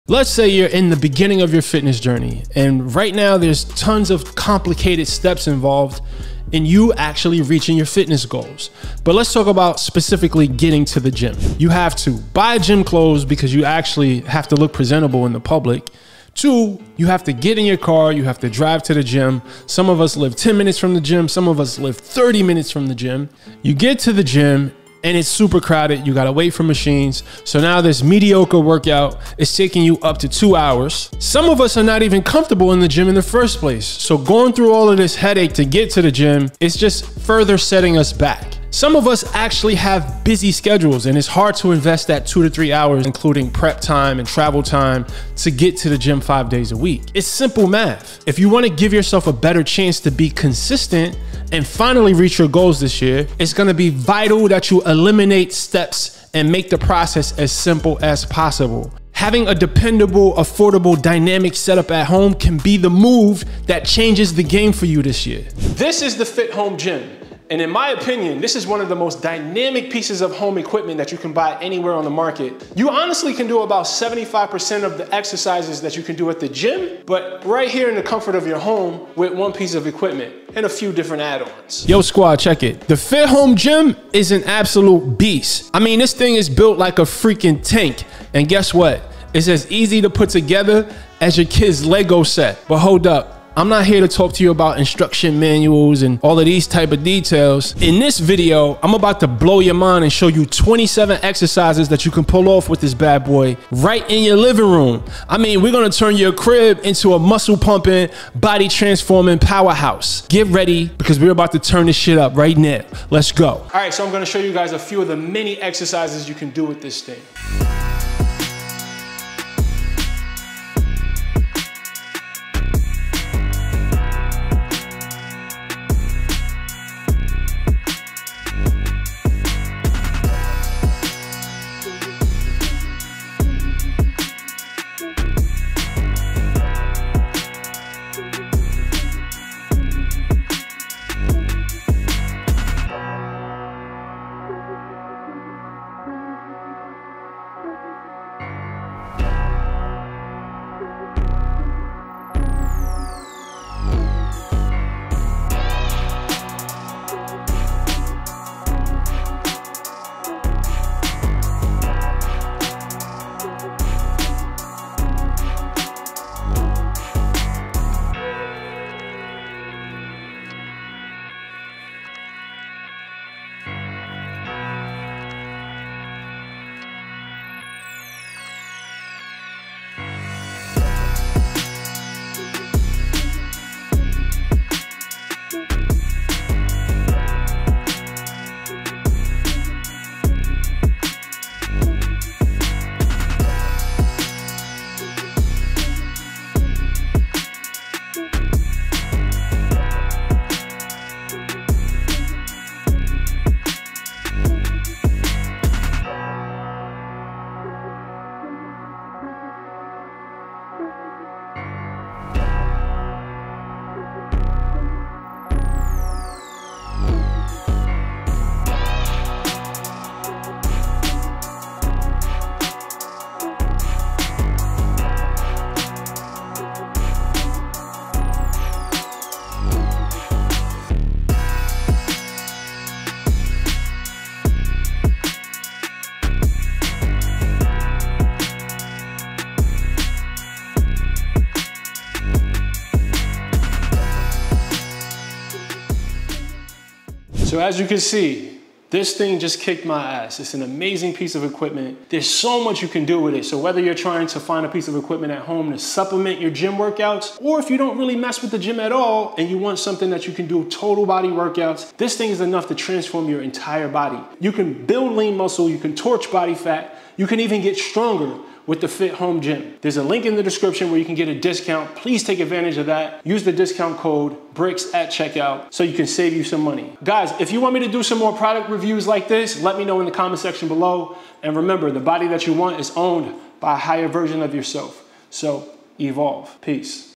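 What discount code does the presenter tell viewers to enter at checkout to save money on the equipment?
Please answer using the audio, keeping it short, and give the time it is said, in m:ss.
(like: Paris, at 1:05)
BRIX, at 4:34.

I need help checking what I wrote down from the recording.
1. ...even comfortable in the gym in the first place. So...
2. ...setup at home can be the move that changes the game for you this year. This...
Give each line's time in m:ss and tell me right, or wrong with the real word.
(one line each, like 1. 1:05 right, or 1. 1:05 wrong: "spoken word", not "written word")
1. 0:32 right
2. 1:01 right.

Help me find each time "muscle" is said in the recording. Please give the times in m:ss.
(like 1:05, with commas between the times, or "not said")
1:47, 4:25.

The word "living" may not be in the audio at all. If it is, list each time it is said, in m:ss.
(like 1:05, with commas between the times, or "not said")
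1:44.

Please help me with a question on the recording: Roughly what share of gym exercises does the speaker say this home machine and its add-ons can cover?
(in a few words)
75%.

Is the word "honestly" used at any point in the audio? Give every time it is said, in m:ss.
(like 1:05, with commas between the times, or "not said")
1:12.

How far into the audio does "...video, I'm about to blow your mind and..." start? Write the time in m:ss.
1:38.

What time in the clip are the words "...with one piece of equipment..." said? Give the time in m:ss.
1:19.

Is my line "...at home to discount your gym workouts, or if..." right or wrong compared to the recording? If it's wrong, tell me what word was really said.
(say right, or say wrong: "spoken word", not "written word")
wrong: "supplement", not "discount".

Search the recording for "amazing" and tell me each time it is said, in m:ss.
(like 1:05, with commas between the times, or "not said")
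4:10.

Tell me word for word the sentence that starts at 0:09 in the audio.
But let's talk about specifically getting to the gym.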